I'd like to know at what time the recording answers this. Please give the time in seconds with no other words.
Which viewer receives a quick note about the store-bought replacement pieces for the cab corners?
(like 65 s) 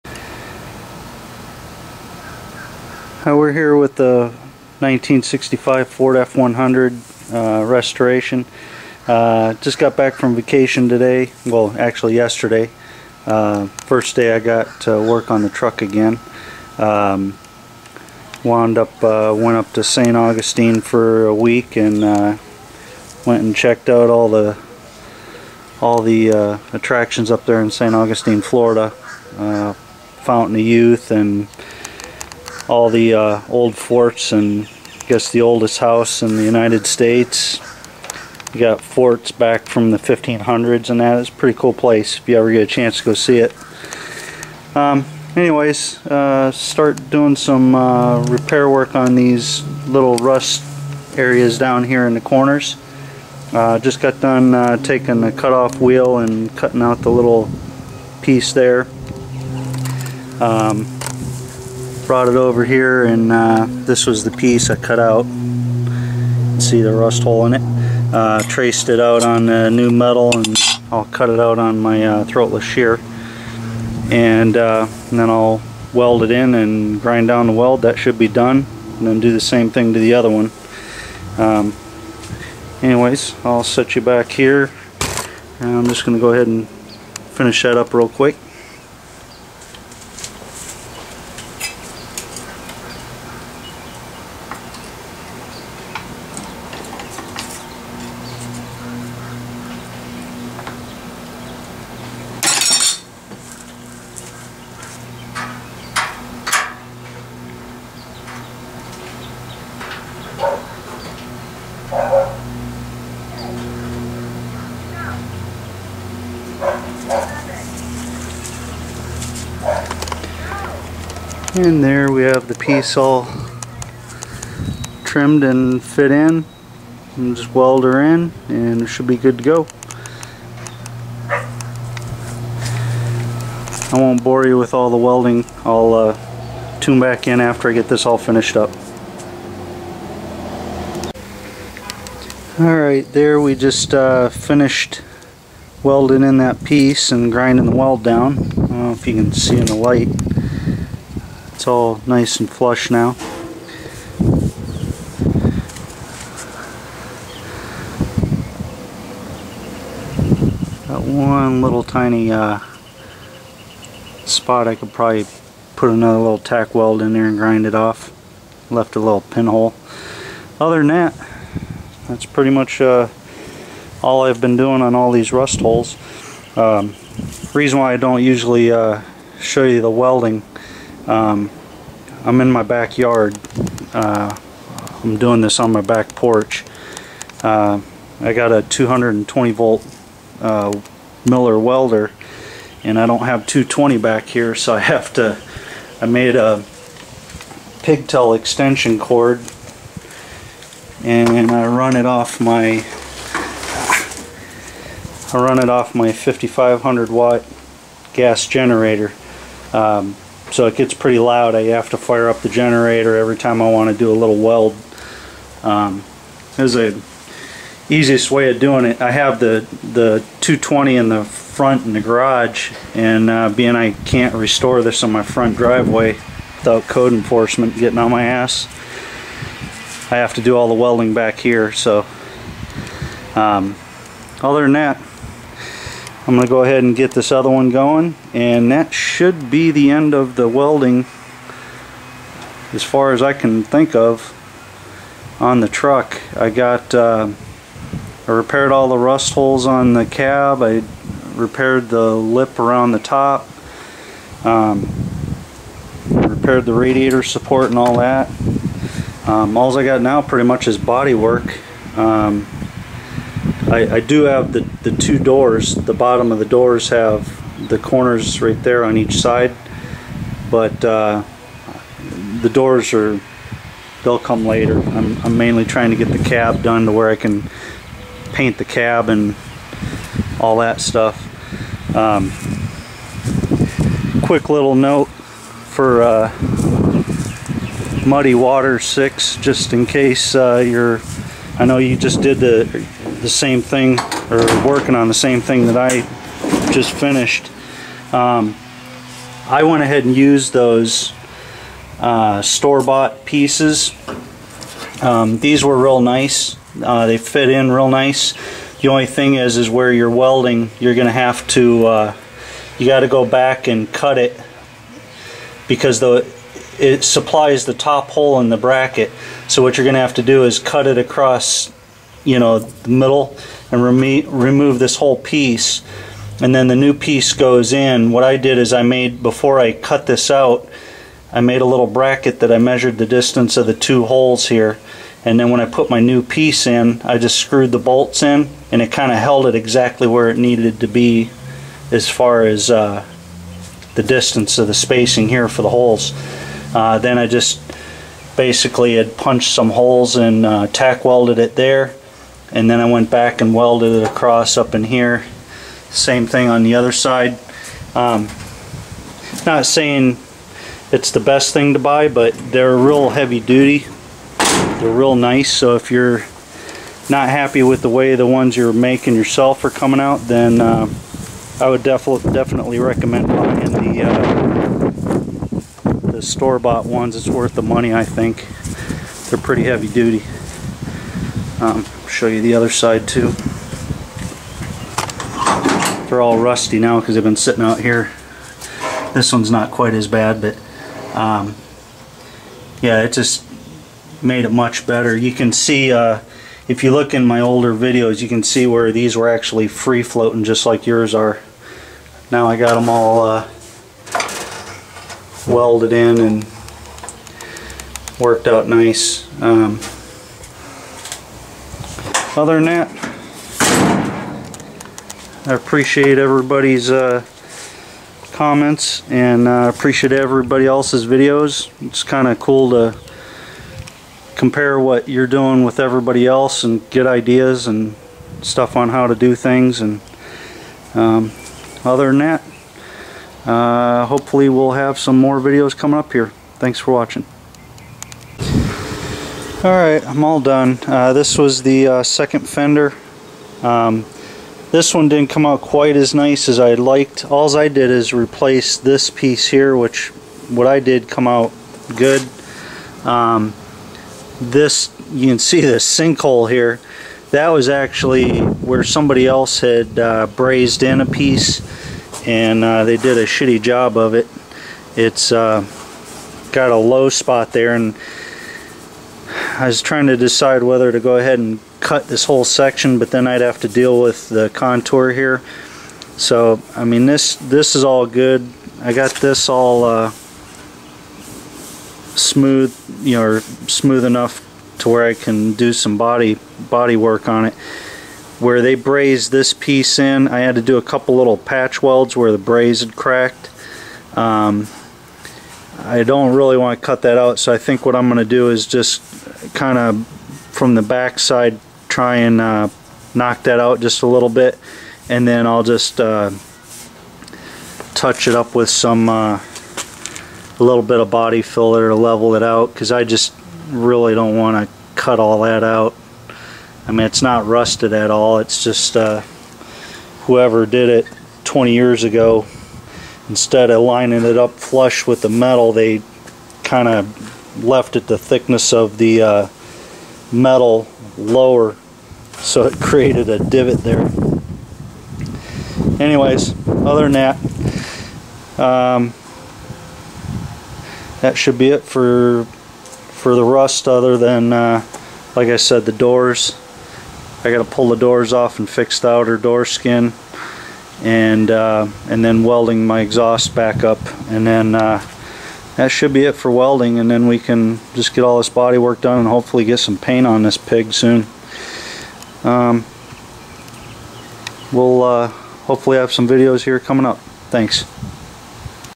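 288 s.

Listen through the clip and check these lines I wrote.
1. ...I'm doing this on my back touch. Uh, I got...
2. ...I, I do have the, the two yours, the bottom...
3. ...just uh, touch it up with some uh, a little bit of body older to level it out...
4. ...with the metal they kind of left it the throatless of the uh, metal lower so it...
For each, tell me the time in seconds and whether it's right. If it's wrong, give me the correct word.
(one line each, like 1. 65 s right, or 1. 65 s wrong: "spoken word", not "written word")
1. 185 s wrong: "porch", not "touch"
2. 263 s wrong: "doors", not "yours"
3. 505 s wrong: "filler", not "older"
4. 525 s wrong: "thickness", not "throatless".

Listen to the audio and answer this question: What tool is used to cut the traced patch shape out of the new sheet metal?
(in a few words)
Throatless shear.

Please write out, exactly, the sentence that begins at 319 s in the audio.
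So what you're going to have to do is cut it across you know, the middle and remo remove this whole piece.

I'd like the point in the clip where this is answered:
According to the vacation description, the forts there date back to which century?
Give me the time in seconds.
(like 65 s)
39 s.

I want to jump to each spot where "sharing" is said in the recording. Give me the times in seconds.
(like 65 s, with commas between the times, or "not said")
not said.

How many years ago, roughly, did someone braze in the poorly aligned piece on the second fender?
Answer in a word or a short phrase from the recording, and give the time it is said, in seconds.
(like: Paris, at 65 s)
20, at 521 s.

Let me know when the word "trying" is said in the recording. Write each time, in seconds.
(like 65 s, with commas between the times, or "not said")
275 s, 469 s.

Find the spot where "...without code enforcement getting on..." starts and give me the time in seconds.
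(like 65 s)
226 s.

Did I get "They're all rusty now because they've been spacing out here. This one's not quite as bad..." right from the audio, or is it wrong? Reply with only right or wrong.
wrong.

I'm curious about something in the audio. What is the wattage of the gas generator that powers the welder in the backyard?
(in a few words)
5500 watts.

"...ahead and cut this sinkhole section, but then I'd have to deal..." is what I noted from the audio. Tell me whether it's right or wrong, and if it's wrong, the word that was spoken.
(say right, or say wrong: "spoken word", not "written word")
wrong: "whole", not "sinkhole".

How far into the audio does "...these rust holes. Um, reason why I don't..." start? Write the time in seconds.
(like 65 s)
175 s.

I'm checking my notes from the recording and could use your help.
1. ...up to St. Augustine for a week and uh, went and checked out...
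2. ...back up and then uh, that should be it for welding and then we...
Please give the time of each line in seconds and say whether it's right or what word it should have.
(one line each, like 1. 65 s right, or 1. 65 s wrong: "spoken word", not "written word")
1. 19 s right
2. 553 s right.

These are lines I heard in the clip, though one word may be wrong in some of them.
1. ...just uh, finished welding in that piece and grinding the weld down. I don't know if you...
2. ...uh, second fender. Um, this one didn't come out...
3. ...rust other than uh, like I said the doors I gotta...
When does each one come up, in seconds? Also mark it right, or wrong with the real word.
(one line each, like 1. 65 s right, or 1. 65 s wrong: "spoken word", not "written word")
1. 143 s right
2. 441 s right
3. 543 s right.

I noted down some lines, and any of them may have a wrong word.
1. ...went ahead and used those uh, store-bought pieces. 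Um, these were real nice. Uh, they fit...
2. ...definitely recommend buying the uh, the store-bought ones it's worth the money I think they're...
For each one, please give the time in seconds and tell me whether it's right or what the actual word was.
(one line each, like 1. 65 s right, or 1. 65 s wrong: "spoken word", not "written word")
1. 299 s right
2. 372 s right.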